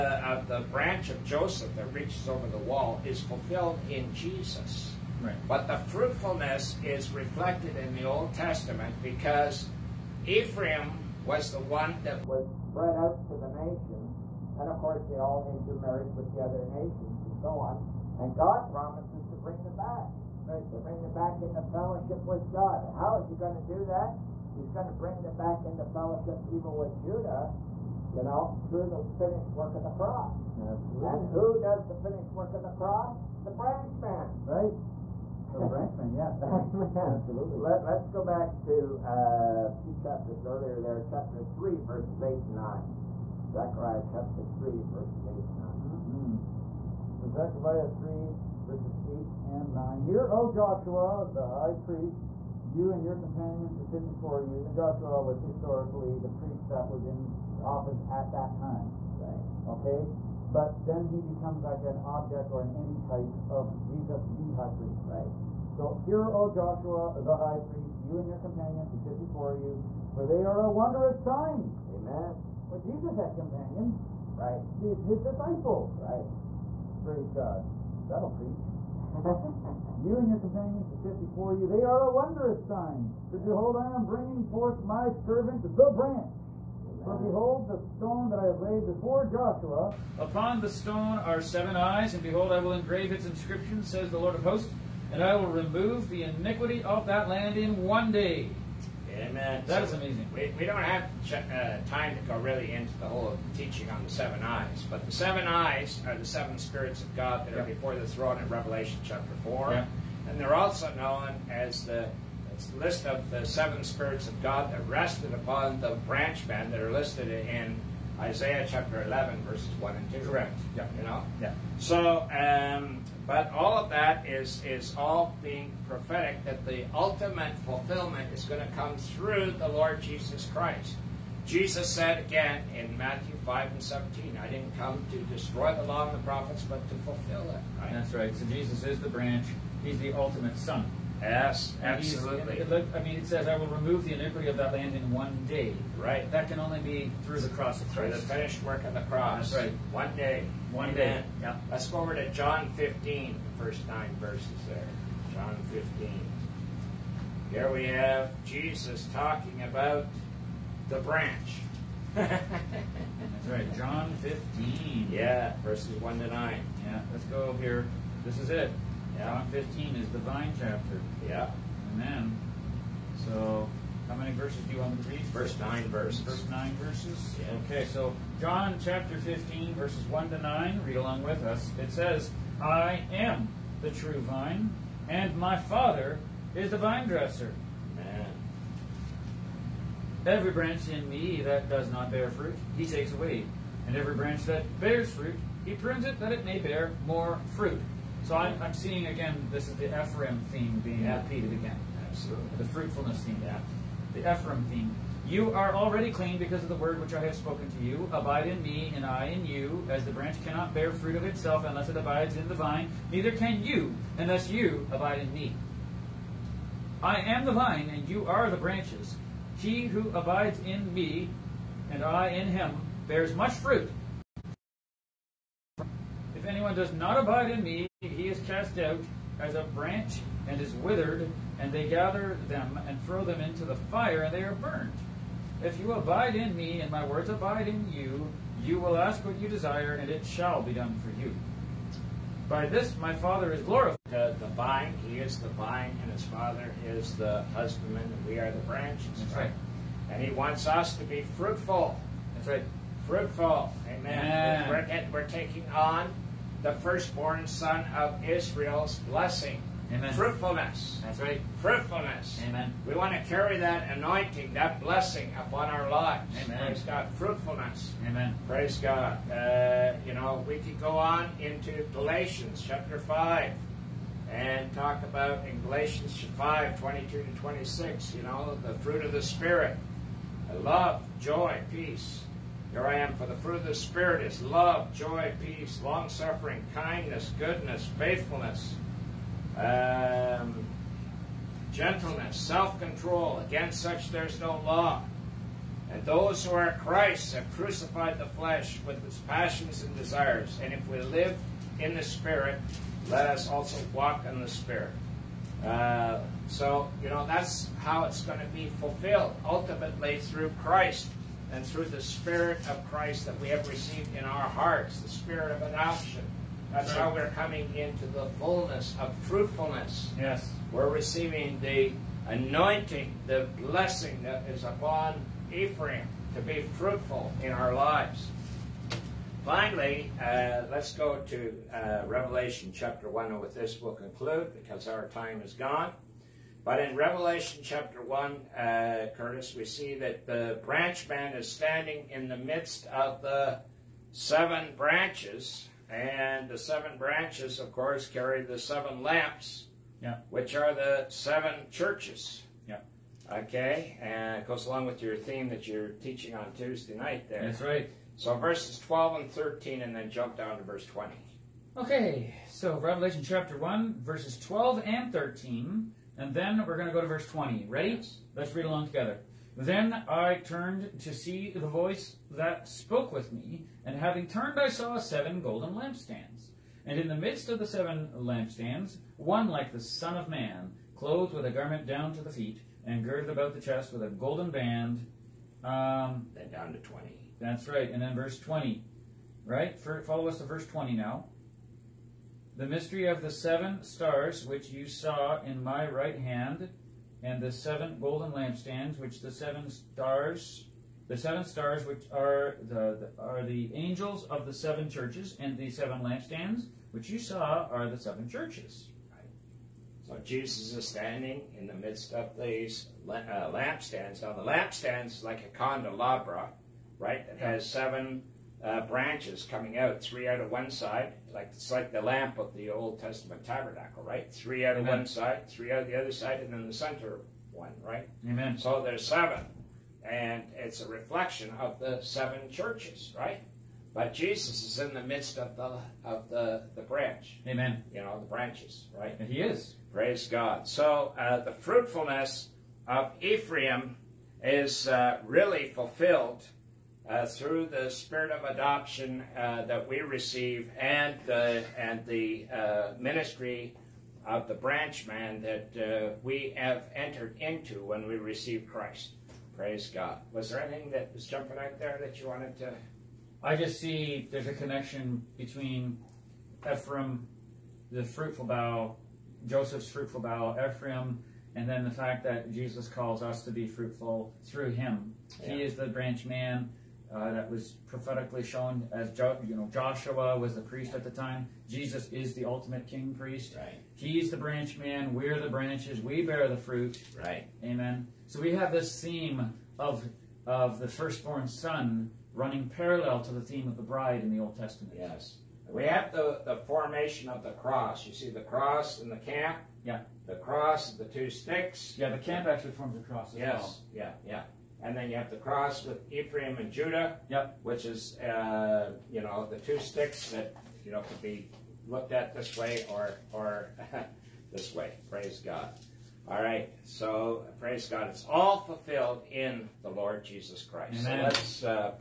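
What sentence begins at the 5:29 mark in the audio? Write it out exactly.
Finally, uh, let's go to uh, Revelation chapter 1, and with this we'll conclude because our time is gone.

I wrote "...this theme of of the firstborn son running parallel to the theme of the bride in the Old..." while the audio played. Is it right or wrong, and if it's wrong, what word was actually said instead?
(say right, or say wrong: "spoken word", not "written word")
right.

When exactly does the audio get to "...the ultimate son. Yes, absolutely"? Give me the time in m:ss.
2:19.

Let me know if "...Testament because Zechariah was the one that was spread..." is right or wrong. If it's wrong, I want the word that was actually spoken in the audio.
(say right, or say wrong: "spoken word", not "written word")
wrong: "Ephraim", not "Zechariah".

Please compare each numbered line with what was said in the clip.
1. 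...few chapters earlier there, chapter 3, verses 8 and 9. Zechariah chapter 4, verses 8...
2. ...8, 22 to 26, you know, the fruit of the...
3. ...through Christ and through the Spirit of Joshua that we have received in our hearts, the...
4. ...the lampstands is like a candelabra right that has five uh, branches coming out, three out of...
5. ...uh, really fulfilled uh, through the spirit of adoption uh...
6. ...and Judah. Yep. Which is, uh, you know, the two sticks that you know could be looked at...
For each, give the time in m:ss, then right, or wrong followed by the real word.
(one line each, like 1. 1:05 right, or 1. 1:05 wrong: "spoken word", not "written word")
1. 0:39 wrong: "3", not "4"
2. 4:36 wrong: "5", not "8"
3. 5:10 wrong: "Christ", not "Joshua"
4. 6:54 wrong: "seven", not "five"
5. 7:24 right
6. 8:26 right.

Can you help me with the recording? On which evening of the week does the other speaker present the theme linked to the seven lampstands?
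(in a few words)
Tuesday.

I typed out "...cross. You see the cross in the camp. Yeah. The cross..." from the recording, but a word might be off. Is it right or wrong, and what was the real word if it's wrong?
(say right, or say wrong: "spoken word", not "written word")
right.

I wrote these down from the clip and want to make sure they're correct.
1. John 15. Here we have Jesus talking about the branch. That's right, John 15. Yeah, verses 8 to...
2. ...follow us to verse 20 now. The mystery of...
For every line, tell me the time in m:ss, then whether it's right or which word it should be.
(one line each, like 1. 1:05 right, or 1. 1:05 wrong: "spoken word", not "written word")
1. 2:35 wrong: "1", not "8"
2. 6:30 right.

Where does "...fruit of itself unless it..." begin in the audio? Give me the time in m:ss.
3:30.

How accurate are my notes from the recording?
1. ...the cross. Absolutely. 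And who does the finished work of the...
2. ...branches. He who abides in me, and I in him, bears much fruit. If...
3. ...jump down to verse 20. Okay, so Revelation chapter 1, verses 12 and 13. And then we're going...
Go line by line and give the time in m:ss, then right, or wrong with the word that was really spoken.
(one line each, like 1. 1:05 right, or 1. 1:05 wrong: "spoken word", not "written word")
1. 0:29 right
2. 3:38 right
3. 6:00 right.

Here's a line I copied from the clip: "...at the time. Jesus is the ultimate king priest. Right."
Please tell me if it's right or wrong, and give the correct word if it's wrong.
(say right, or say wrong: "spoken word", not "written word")
right.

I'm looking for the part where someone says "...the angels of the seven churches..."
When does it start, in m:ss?
6:43.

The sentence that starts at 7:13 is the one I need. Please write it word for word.
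But Jesus is in the midst of the of the the branch.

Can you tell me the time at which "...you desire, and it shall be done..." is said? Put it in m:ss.
3:59.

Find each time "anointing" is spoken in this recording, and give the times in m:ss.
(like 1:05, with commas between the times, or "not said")
4:23, 5:22.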